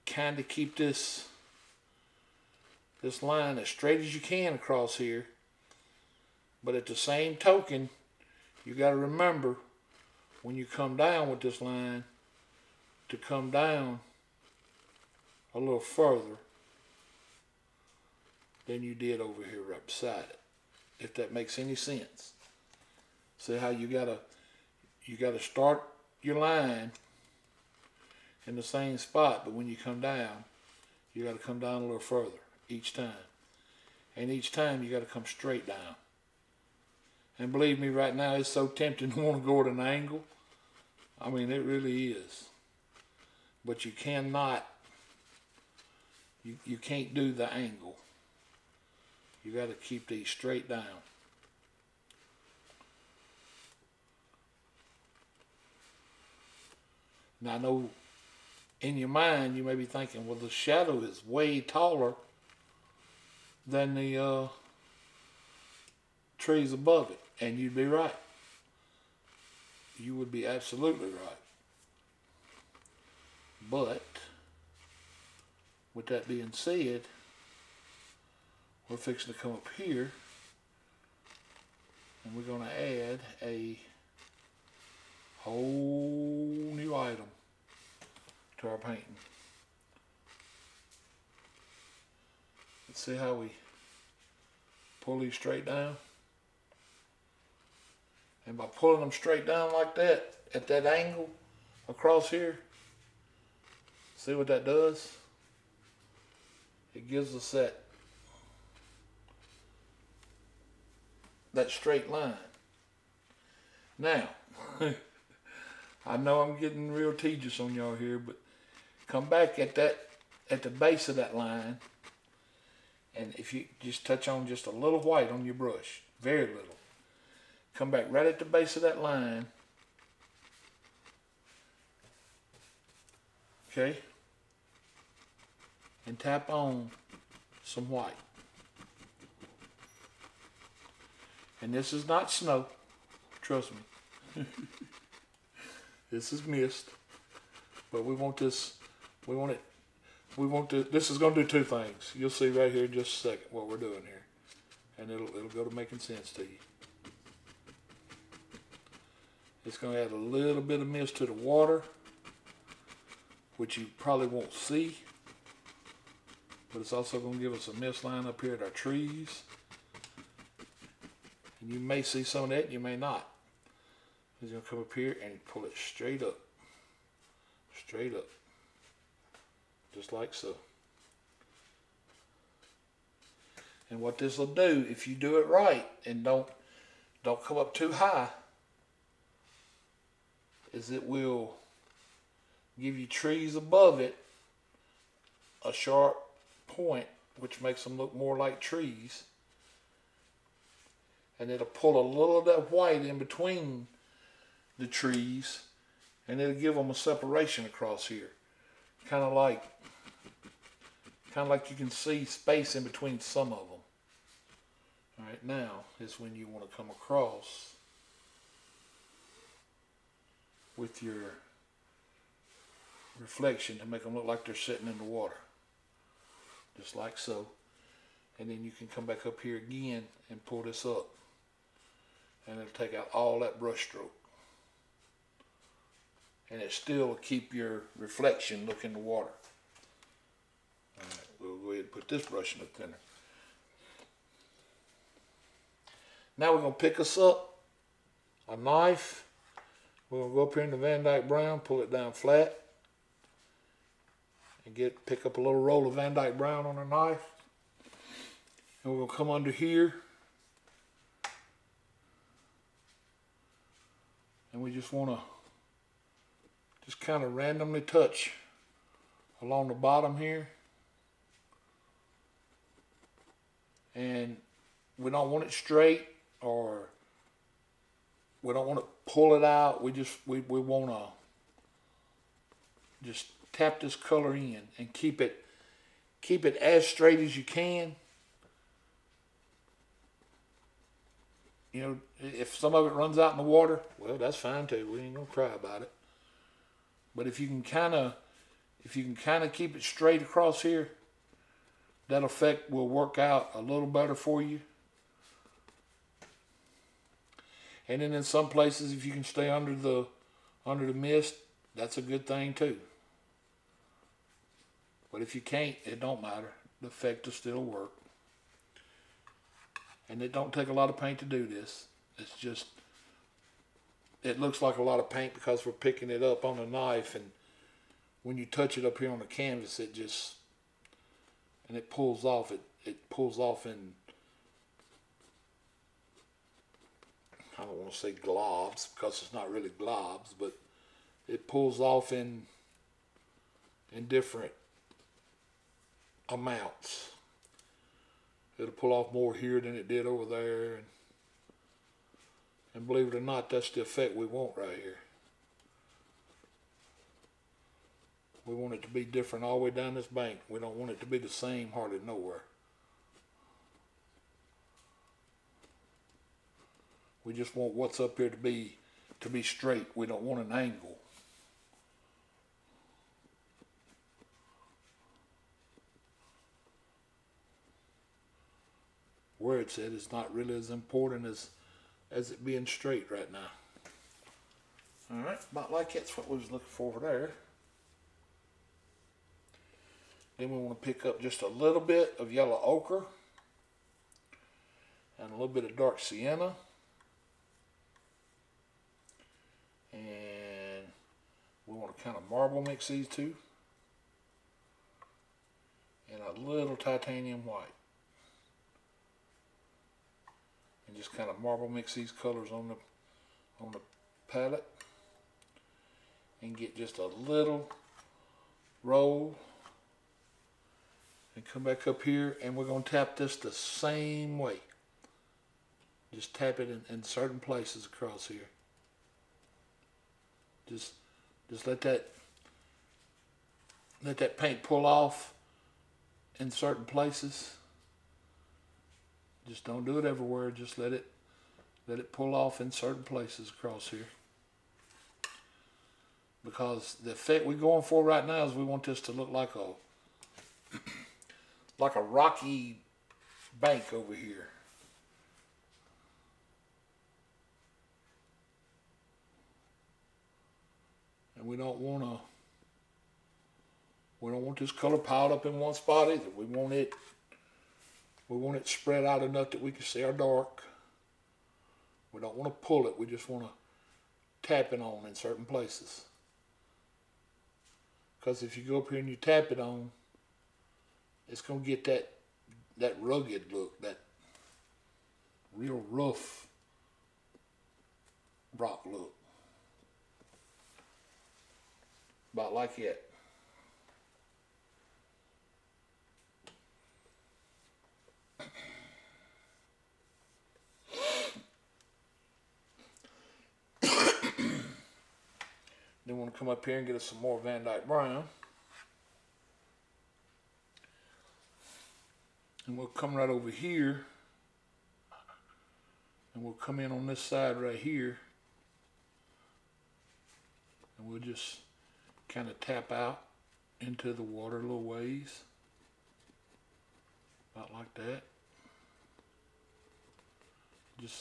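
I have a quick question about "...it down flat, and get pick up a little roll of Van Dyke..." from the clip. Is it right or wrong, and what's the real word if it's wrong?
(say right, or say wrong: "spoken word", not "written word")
right.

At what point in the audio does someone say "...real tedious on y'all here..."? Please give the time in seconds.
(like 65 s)
116 s.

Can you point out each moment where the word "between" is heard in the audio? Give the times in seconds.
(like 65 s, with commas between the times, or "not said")
203 s, 212 s.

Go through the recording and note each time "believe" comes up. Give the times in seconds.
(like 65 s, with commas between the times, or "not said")
37 s, 352 s.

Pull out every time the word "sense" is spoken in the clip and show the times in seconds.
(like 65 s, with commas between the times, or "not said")
21 s, 155 s.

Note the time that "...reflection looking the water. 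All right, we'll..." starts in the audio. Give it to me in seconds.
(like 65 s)
237 s.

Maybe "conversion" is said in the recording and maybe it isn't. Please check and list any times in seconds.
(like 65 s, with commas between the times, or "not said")
not said.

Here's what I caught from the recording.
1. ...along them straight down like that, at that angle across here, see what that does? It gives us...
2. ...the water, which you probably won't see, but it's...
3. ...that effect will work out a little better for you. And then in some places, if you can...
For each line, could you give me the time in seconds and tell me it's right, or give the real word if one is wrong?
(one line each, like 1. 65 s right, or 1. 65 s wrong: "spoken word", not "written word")
1. 98 s wrong: "pulling", not "along"
2. 161 s right
3. 302 s right.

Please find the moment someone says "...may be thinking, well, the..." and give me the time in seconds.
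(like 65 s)
59 s.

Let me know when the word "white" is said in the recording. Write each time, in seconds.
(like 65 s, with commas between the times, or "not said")
124 s, 137 s, 202 s, 407 s.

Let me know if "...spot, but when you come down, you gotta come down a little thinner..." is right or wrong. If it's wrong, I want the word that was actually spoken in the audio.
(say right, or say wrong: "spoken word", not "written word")
wrong: "further", not "thinner".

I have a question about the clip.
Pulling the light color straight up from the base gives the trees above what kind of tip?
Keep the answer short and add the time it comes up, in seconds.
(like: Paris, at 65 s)
A sharp point, at 195 s.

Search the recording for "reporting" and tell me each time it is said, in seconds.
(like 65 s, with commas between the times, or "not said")
not said.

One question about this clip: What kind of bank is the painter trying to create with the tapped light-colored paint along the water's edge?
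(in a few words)
A rocky bank.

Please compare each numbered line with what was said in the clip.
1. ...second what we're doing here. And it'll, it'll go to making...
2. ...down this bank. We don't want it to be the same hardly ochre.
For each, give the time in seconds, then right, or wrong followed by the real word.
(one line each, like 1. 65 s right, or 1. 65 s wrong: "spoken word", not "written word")
1. 153 s right
2. 359 s wrong: "nowhere", not "ochre".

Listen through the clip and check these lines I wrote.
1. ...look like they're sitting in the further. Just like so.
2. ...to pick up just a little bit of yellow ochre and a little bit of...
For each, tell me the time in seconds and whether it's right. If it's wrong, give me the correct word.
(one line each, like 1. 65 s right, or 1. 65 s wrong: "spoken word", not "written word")
1. 224 s wrong: "water", not "further"
2. 390 s right.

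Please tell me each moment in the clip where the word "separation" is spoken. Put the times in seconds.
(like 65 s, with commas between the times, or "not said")
206 s.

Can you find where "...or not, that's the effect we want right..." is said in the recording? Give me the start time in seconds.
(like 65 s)
353 s.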